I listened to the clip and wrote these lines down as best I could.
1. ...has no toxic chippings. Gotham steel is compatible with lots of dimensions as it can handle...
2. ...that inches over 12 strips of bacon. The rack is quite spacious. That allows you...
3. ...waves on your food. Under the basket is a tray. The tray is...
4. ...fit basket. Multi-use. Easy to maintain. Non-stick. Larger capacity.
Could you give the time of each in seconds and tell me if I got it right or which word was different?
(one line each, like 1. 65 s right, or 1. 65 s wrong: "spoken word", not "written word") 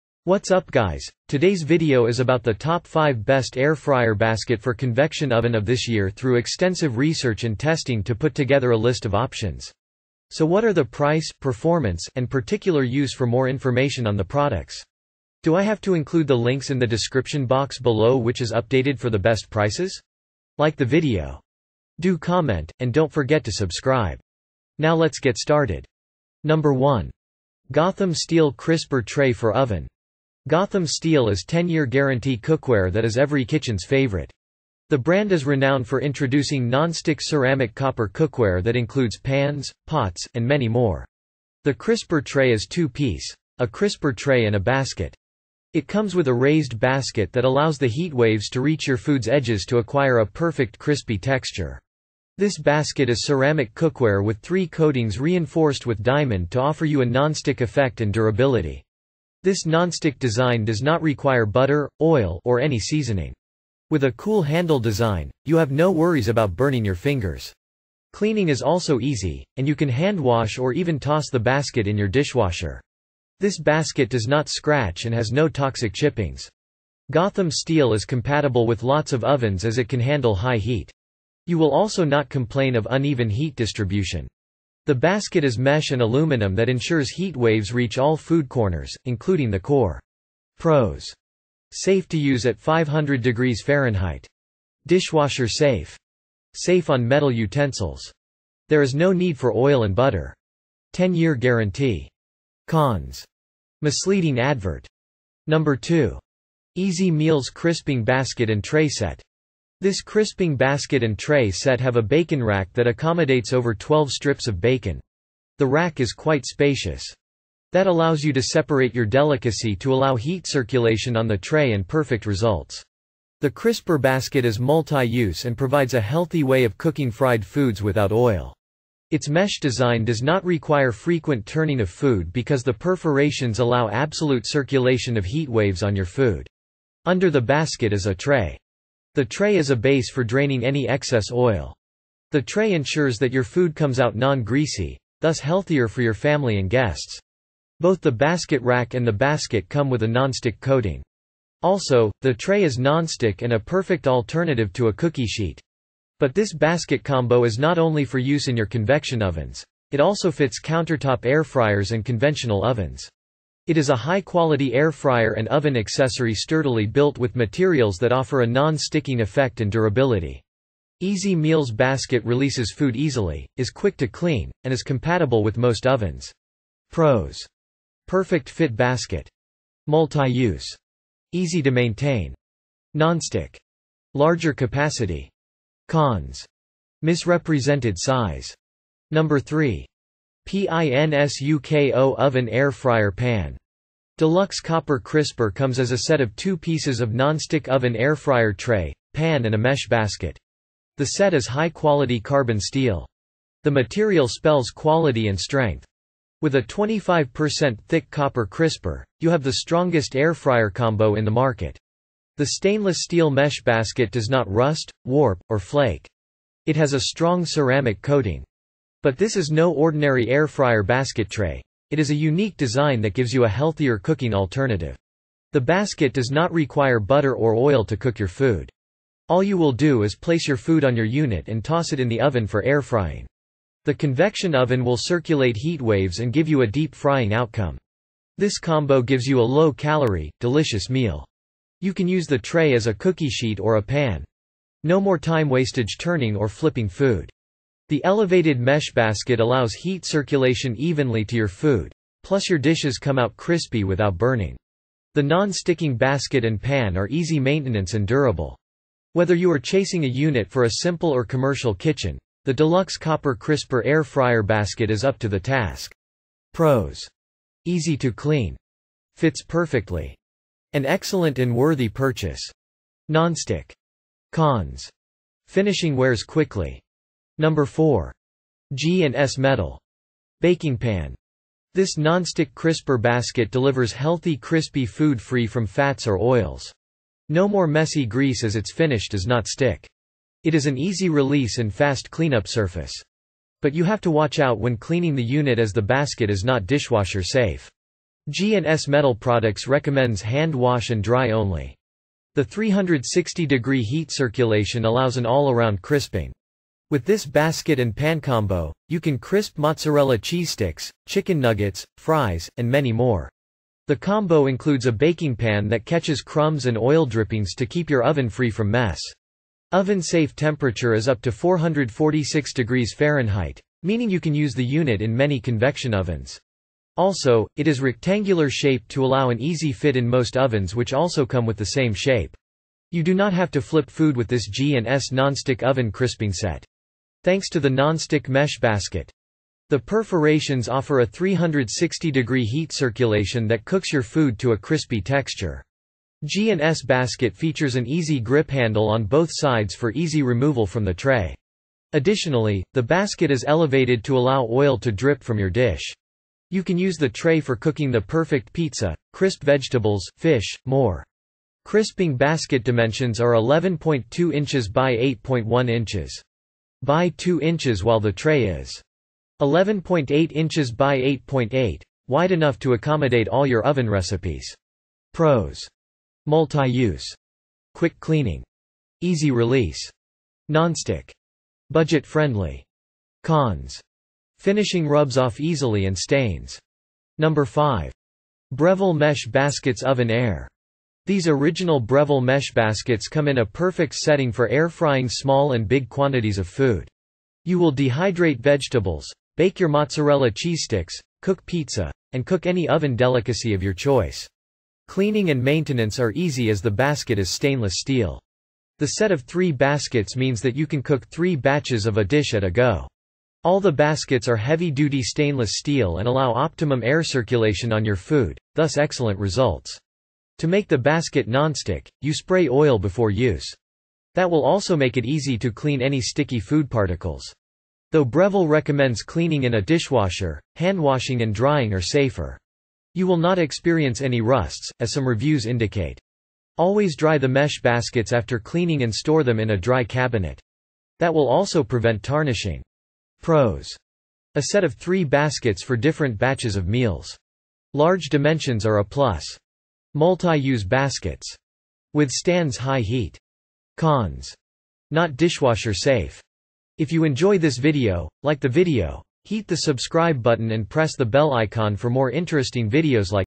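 1. 75 s wrong: "ovens", not "dimensions"
2. 112 s wrong: "accommodates", not "inches"
3. 135 s right
4. 178 s right.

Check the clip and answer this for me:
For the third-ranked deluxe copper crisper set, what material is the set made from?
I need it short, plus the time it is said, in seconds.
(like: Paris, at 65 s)
Carbon steel, at 202 s.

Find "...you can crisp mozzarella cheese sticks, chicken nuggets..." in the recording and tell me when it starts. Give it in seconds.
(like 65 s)
308 s.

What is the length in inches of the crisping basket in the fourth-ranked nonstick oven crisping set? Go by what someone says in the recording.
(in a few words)
11.2 inches.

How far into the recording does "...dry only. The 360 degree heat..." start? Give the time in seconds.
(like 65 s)
301 s.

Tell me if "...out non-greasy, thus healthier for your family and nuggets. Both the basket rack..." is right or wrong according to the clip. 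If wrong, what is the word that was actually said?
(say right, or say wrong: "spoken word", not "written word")
wrong: "guests", not "nuggets".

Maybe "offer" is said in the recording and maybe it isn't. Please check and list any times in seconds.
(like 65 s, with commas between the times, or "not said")
56 s, 168 s, 340 s.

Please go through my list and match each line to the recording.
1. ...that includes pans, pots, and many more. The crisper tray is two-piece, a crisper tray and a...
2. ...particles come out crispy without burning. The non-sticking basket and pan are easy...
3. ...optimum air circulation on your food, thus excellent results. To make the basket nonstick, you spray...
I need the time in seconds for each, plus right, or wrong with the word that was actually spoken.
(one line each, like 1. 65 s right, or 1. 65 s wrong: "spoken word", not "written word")
1. 38 s right
2. 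252 s wrong: "dishes", not "particles"
3. 416 s right.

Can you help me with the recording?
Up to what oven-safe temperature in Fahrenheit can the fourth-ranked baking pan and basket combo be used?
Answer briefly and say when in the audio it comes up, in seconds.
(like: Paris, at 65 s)
446 degrees Fahrenheit, at 321 s.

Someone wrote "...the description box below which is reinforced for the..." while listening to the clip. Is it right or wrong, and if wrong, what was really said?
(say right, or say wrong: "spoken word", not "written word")
wrong: "updated", not "reinforced".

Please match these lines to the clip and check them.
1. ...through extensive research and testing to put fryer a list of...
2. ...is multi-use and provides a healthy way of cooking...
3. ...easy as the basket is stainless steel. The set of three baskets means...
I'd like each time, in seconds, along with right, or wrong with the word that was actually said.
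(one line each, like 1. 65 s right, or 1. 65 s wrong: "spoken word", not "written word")
1. 6 s wrong: "together", not "fryer"
2. 124 s right
3. 406 s right.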